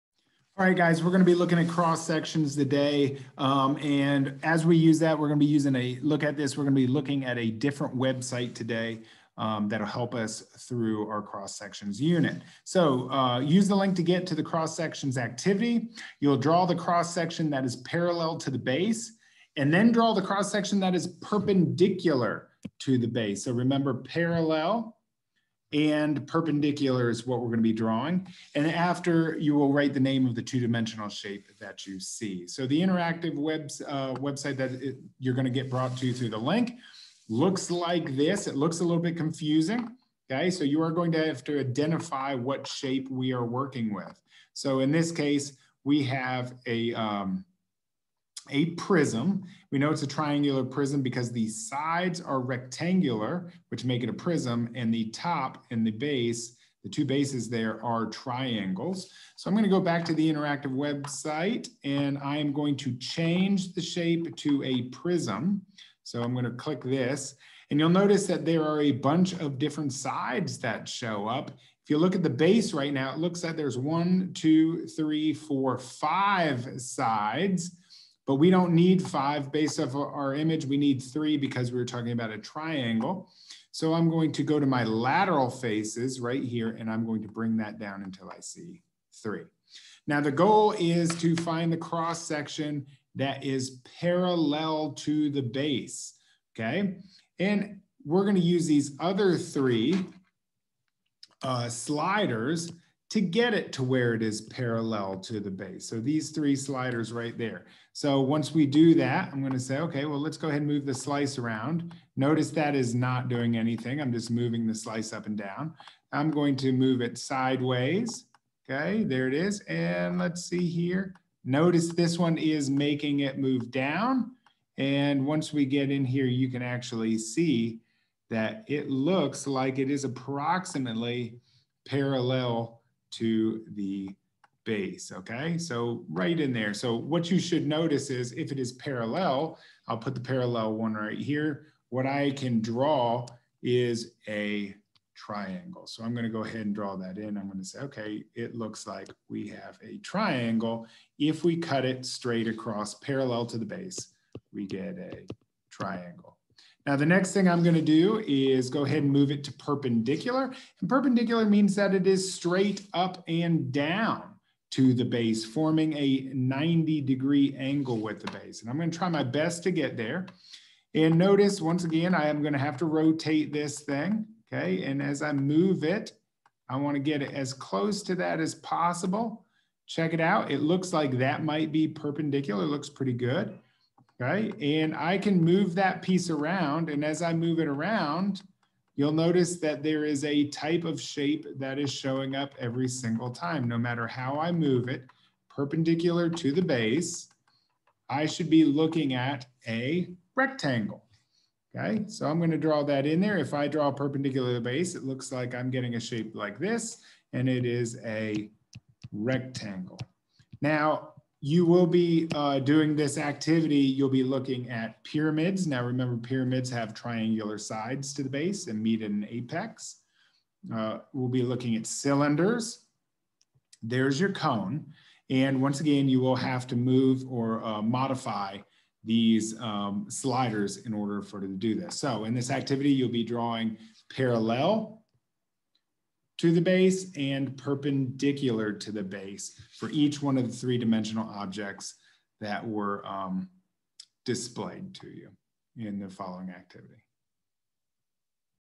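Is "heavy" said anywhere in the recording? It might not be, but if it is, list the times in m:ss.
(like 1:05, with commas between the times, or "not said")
not said.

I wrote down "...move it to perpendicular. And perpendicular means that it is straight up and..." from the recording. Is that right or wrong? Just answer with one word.
right.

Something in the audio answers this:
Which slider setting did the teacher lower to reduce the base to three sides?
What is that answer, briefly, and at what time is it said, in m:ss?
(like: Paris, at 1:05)
lateral faces, at 1:24.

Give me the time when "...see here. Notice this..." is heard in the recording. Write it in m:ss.
2:00.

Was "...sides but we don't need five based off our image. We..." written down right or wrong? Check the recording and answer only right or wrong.
right.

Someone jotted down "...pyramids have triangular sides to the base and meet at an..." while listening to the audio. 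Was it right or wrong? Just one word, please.
right.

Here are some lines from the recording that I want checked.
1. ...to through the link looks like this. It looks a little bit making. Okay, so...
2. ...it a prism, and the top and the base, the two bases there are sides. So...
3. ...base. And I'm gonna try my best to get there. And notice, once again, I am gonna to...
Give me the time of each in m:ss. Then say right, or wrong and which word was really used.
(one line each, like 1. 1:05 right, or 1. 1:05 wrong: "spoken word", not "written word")
1. 0:35 wrong: "confusing", not "making"
2. 0:54 wrong: "triangles", not "sides"
3. 2:48 right.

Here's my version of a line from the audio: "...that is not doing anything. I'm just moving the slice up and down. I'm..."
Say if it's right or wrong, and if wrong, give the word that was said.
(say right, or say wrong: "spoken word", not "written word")
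right.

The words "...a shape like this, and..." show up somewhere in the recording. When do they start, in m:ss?
3:25.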